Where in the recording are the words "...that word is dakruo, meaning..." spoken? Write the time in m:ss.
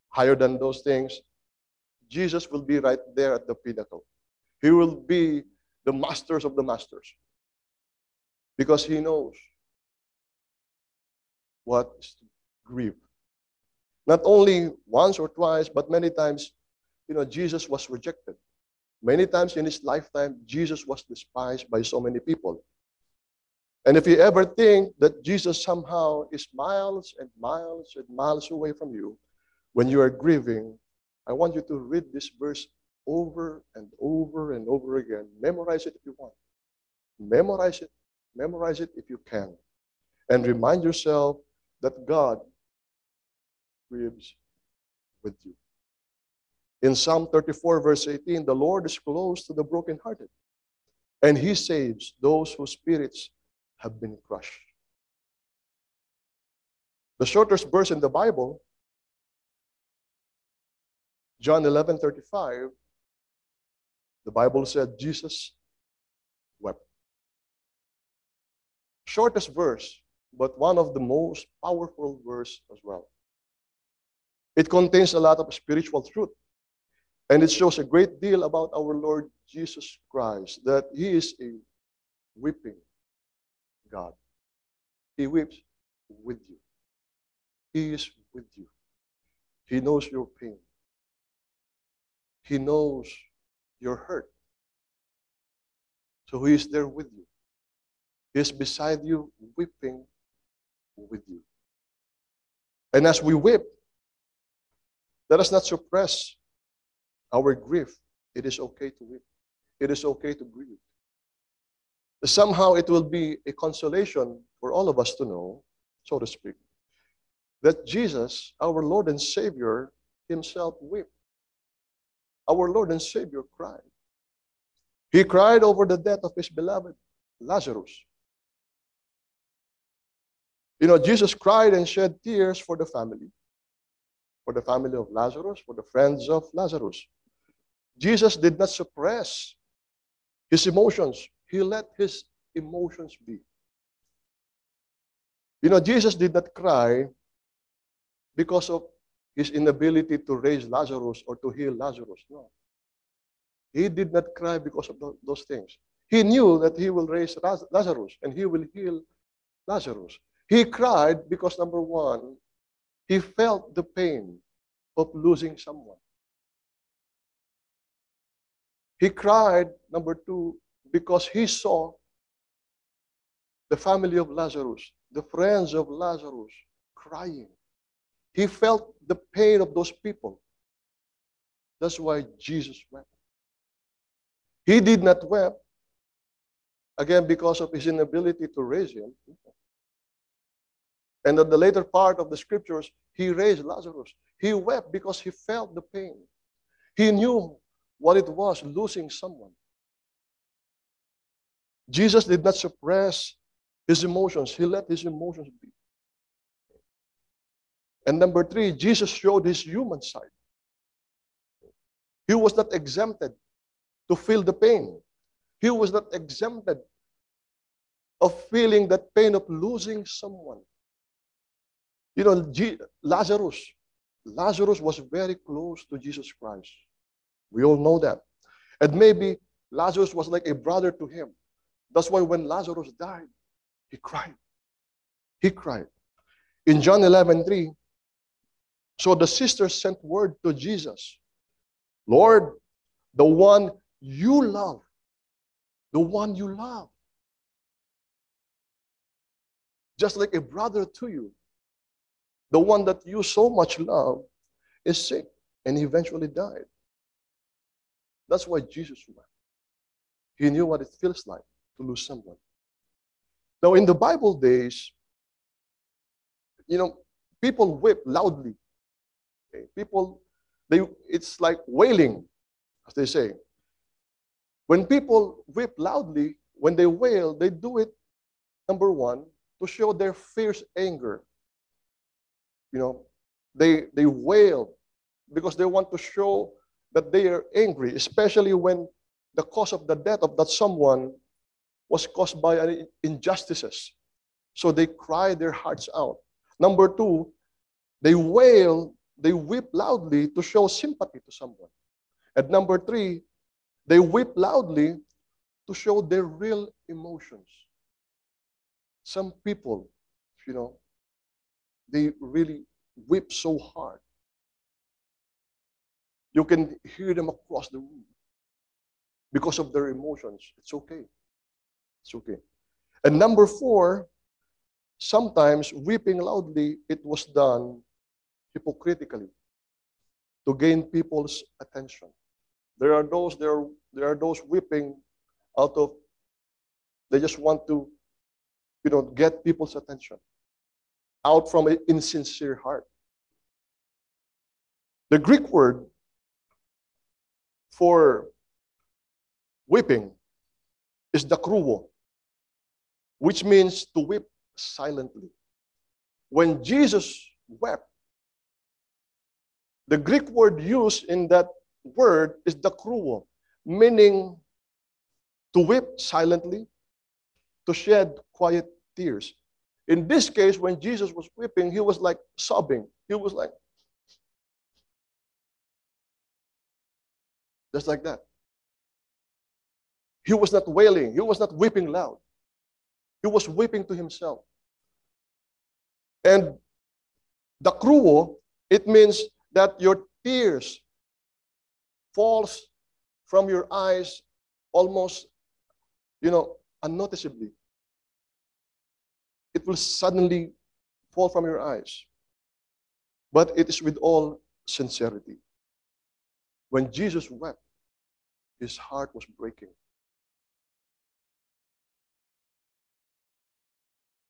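6:01.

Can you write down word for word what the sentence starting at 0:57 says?
The shortest verse in the Bible, John 11 35, the Bible said Jesus wept.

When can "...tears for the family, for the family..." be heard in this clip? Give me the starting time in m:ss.
2:12.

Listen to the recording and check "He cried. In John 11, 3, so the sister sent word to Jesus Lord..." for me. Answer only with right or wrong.
right.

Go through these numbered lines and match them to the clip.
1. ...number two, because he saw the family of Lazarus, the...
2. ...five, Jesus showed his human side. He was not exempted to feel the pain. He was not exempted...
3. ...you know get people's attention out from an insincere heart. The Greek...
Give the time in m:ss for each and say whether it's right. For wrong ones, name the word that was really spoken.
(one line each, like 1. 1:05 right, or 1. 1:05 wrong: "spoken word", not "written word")
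1. 2:49 right
2. 3:28 wrong: "three", not "five"
3. 5:38 right.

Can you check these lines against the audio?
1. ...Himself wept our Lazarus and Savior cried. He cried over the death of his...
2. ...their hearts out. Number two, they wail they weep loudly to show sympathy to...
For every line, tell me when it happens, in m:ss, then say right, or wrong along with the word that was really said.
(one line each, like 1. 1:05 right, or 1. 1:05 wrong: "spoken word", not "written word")
1. 2:00 wrong: "Lord", not "Lazarus"
2. 4:55 right.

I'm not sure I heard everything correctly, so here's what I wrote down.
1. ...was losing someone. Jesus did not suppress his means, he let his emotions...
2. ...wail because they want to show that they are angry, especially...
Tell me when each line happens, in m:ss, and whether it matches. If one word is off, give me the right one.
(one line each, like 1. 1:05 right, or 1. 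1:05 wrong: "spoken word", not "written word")
1. 3:18 wrong: "emotions", not "means"
2. 4:44 right.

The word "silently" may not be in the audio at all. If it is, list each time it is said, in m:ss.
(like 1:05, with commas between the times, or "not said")
5:54, 6:05.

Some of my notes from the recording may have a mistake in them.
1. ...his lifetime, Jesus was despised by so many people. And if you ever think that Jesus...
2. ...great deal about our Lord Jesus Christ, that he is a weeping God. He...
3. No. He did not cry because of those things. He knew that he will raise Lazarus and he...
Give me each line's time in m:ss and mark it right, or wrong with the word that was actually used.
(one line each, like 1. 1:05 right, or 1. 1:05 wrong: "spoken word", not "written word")
1. 0:19 right
2. 1:17 right
3. 2:32 right.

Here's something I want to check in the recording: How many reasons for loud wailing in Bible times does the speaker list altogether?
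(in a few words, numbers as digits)
4.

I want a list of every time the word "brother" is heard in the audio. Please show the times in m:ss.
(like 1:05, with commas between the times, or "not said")
3:50, 4:10.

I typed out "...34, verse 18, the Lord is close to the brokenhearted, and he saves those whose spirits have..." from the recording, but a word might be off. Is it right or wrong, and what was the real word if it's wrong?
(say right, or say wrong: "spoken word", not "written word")
right.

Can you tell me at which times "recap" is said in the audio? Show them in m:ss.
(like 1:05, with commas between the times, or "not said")
not said.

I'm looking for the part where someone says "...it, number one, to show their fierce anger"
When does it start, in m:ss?
4:37.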